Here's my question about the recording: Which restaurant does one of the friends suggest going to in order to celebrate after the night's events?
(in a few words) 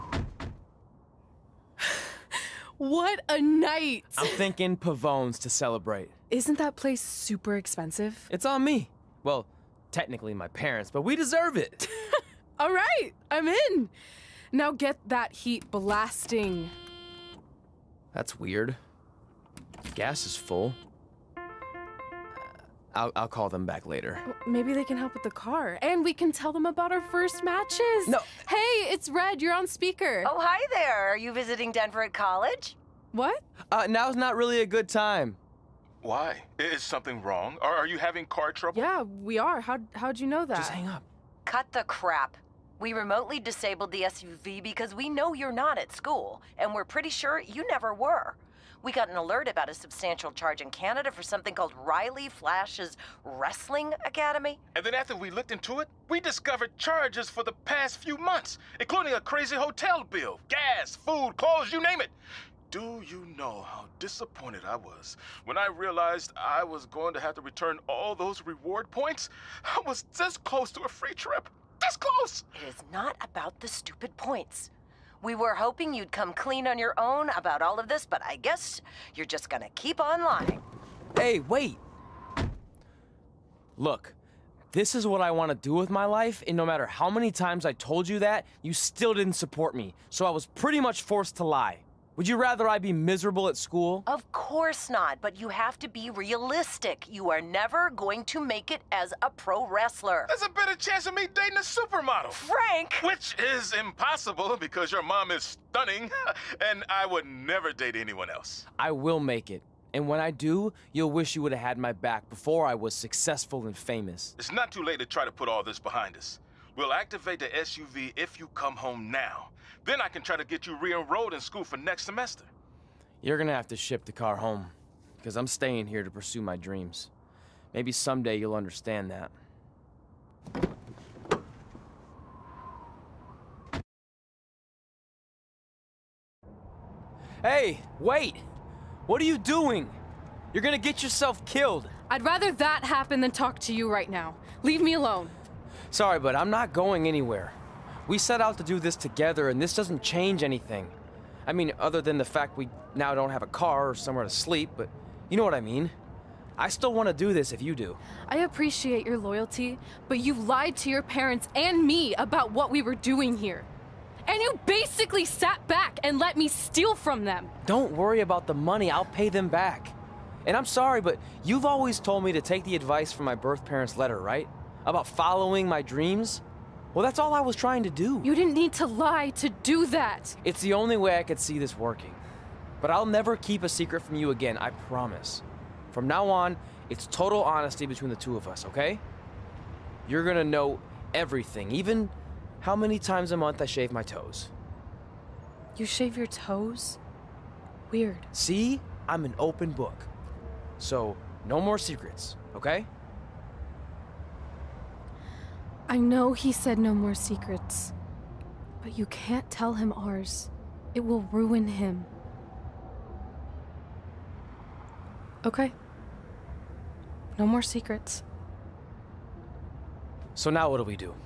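Pavone's.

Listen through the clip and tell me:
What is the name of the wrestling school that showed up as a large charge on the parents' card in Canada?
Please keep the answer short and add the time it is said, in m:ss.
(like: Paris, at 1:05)
Riley Flash's Wrestling Academy, at 0:51.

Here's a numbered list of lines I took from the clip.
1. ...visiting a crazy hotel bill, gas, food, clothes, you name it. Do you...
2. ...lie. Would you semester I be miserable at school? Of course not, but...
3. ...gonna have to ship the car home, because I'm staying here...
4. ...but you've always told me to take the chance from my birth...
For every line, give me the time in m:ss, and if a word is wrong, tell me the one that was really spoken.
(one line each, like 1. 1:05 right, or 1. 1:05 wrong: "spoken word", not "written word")
1. 0:58 wrong: "including", not "visiting"
2. 1:31 wrong: "rather", not "semester"
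3. 2:03 right
4. 2:51 wrong: "advice", not "chance".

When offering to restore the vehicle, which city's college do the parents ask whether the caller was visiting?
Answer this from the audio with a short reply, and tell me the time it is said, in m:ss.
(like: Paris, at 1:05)
Denver, at 0:31.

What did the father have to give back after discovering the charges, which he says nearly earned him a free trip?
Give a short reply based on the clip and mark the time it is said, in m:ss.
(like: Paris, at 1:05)
reward points, at 1:08.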